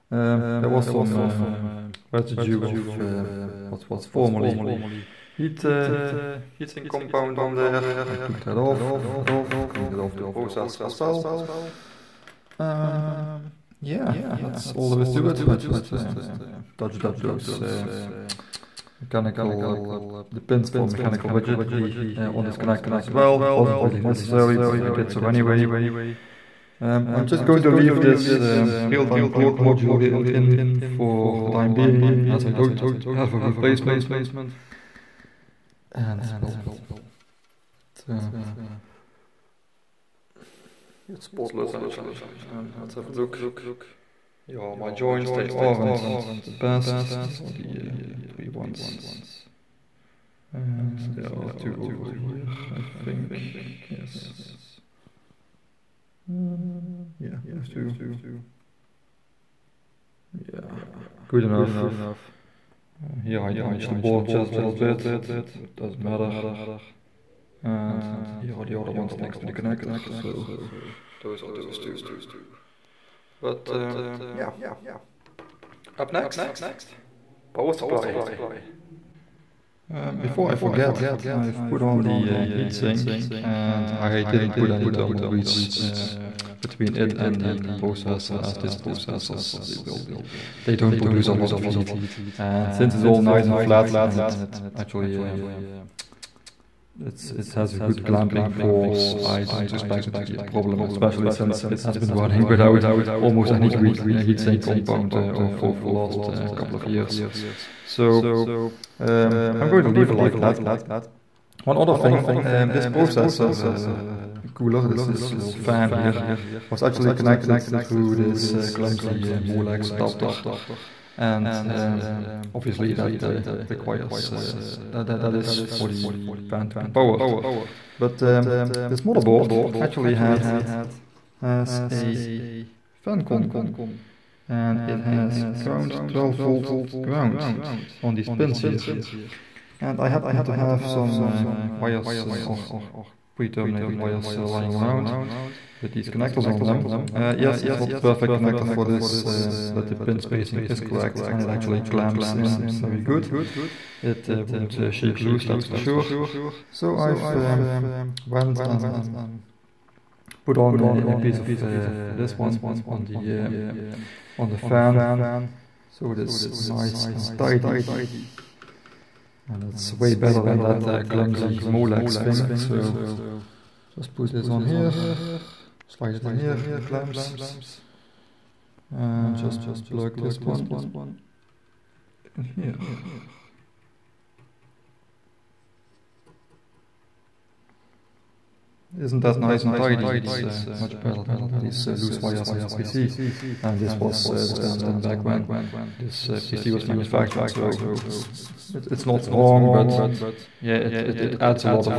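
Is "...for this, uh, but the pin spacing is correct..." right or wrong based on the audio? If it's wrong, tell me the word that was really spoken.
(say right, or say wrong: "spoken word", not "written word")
right.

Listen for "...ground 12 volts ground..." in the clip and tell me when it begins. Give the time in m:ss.
2:15.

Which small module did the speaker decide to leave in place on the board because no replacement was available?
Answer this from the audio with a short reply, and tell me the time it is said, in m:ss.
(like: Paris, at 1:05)
real-time clock module, at 0:28.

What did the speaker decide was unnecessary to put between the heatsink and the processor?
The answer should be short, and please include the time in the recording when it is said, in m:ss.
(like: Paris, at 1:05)
thermal grease, at 1:24.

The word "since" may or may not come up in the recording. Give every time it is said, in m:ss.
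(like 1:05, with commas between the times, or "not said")
1:32, 1:41.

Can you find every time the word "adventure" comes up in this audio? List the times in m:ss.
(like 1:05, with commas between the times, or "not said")
not said.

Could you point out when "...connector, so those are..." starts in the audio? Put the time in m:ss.
1:09.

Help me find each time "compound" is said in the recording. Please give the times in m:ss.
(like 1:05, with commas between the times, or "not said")
0:06, 1:44.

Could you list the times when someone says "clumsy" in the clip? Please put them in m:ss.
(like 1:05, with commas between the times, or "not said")
1:58, 2:51.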